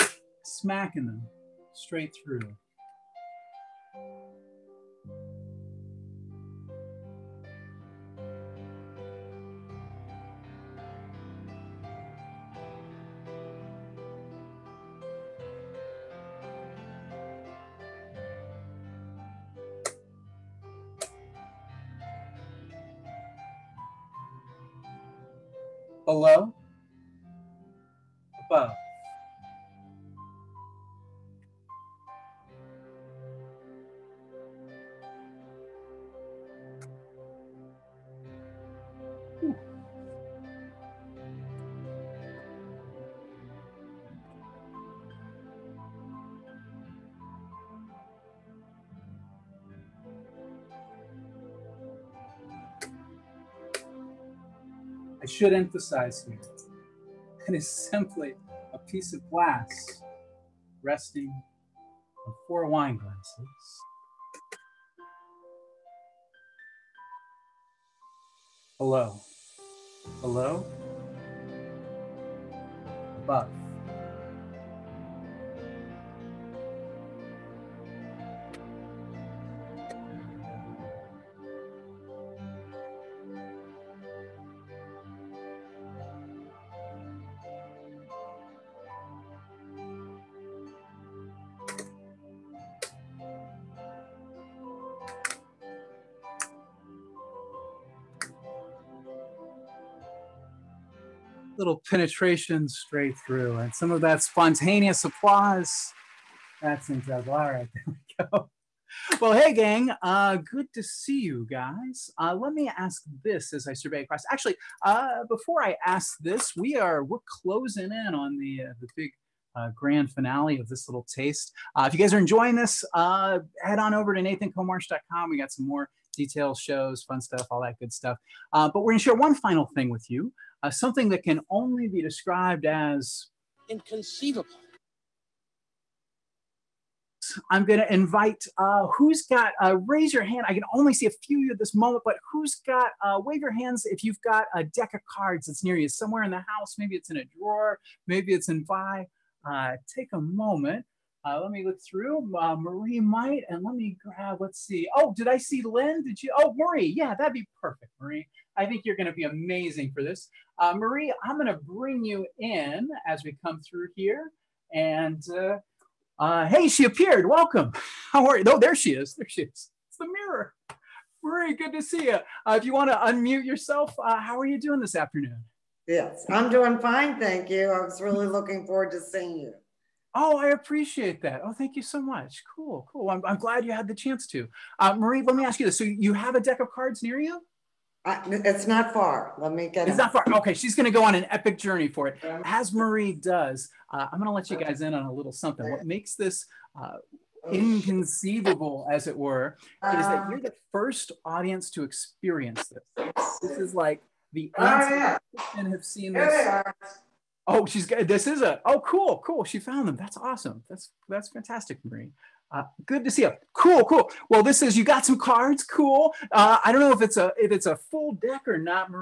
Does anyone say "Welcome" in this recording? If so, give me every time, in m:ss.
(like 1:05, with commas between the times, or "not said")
2:47.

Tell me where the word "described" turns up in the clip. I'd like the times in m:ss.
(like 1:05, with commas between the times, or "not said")
2:12.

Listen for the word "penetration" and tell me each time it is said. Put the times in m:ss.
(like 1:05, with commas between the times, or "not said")
1:41.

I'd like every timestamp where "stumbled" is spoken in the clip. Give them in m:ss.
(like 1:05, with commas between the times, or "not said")
not said.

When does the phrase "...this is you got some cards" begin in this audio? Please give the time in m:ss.
3:34.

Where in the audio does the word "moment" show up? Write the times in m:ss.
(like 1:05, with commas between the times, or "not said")
2:21, 2:30.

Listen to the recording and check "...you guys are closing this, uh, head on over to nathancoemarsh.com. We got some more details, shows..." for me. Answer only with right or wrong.
wrong.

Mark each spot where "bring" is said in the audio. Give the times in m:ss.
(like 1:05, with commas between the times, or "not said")
2:41.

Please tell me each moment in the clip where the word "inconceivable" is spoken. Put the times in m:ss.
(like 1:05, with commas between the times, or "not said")
2:13, 3:17.